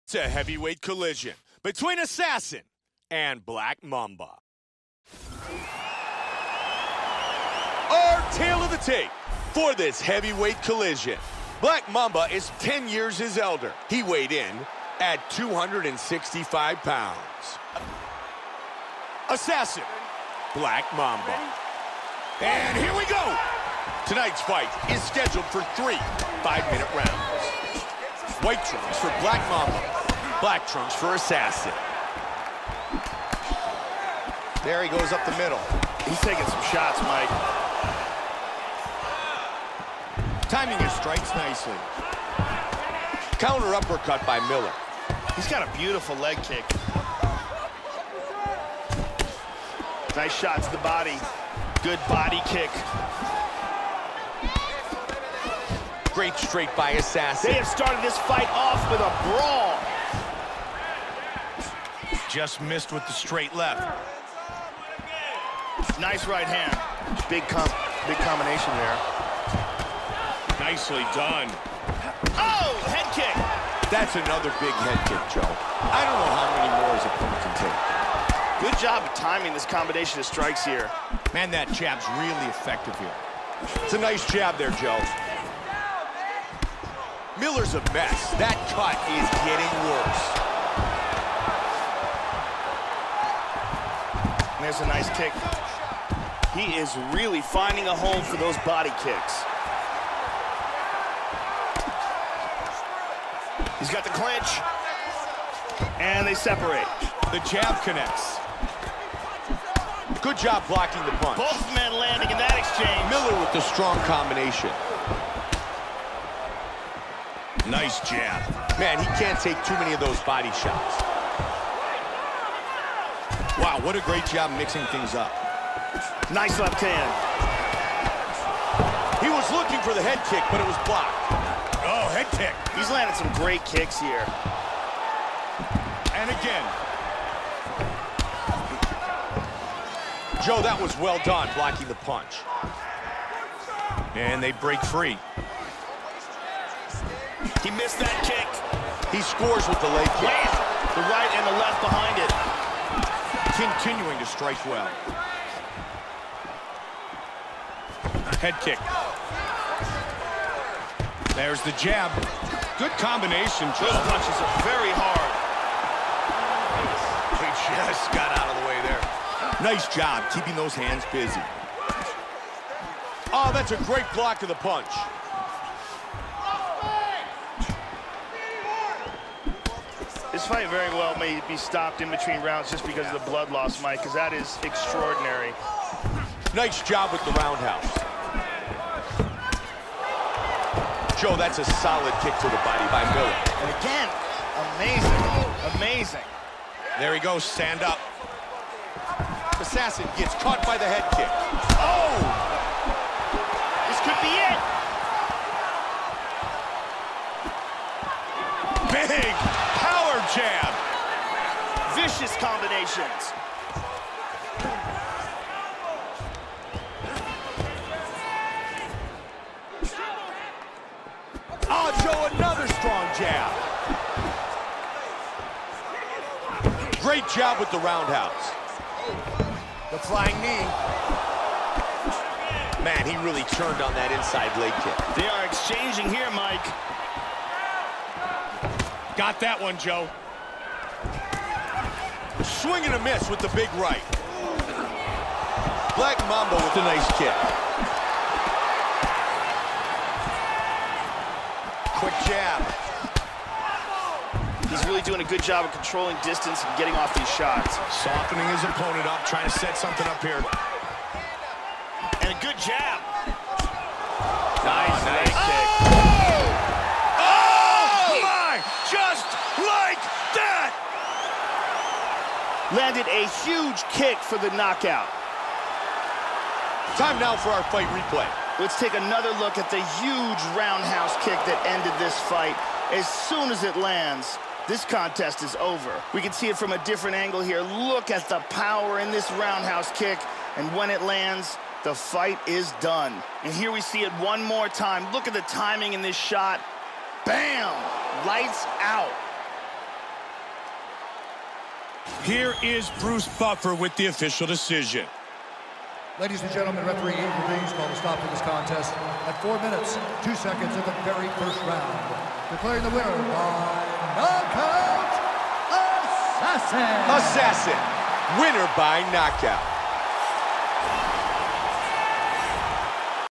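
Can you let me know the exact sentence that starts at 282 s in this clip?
As soon as it lands, this contest is over.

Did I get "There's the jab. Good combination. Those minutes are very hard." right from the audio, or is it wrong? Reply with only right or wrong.
wrong.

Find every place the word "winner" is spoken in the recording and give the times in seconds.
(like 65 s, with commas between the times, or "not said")
312 s, 318 s.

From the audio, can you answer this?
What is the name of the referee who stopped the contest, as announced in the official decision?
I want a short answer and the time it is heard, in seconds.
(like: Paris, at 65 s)
Ian Reeves, at 307 s.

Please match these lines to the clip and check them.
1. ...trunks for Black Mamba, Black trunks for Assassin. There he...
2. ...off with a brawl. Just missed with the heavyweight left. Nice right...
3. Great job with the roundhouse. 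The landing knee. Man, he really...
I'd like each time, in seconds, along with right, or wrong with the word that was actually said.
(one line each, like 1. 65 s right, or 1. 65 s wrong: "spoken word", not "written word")
1. 28 s right
2. 58 s wrong: "straight", not "heavyweight"
3. 227 s wrong: "flying", not "landing".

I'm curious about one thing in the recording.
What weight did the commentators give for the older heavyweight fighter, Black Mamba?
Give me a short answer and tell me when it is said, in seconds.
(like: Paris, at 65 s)
265 pounds, at 15 s.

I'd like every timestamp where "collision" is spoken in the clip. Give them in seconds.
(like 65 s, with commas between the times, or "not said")
0 s, 10 s.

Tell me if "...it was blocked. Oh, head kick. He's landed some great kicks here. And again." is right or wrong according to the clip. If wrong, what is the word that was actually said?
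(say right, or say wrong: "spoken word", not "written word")
right.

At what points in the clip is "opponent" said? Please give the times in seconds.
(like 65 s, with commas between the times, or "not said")
77 s, 258 s.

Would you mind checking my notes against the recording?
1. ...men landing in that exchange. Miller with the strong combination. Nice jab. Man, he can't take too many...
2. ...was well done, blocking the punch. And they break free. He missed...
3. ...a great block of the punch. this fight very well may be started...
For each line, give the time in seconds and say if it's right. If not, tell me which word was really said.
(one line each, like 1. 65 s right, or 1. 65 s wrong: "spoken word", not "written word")
1. 111 s right
2. 140 s right
3. 173 s wrong: "stopped", not "started".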